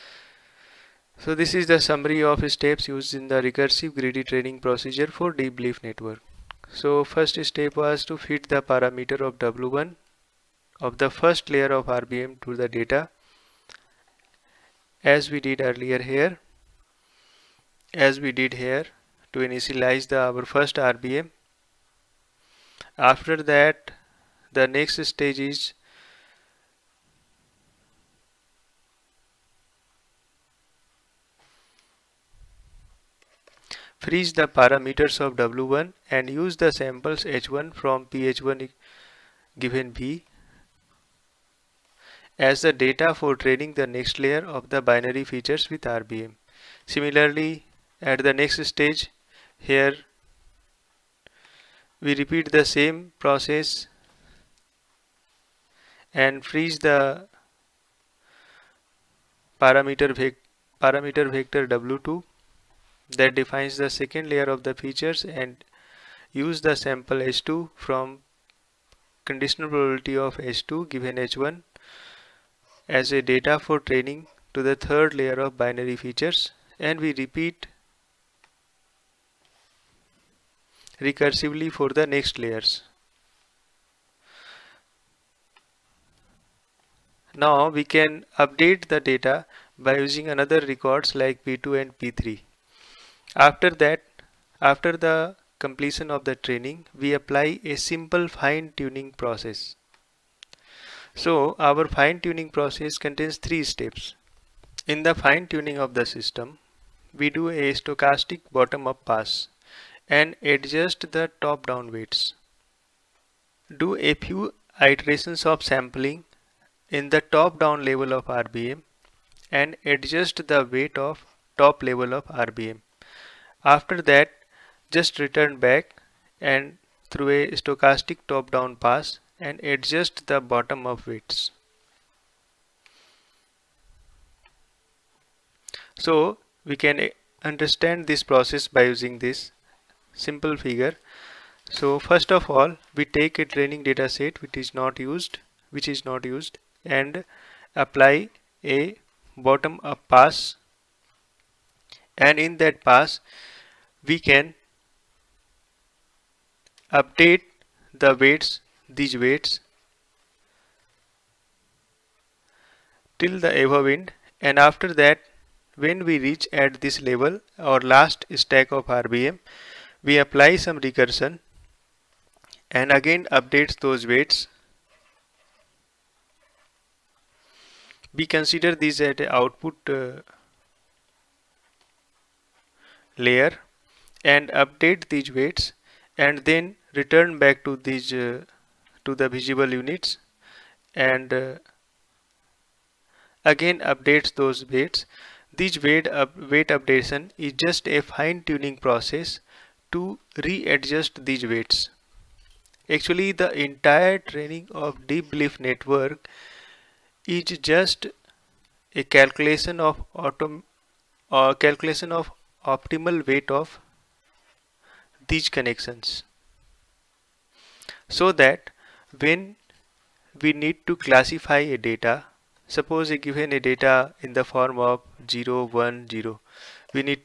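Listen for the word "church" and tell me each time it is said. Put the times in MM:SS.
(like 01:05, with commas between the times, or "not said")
not said.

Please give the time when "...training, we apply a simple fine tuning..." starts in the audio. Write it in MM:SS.
01:36.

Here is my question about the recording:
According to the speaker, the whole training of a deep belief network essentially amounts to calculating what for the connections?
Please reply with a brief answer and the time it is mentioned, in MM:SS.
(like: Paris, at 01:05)
Optimal weight, at 03:32.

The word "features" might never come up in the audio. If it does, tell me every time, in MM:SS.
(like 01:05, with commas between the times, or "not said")
00:45, 01:04, 01:15.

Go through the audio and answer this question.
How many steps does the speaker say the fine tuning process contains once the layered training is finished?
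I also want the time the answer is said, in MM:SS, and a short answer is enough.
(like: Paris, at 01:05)
3, at 01:43.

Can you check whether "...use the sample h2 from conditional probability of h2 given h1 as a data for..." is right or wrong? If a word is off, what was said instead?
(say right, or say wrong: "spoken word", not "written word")
right.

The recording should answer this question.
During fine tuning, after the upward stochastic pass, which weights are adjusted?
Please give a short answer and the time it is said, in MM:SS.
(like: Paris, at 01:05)
Top down weights, at 01:51.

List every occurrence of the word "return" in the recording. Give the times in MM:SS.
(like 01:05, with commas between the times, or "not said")
02:05, 03:06.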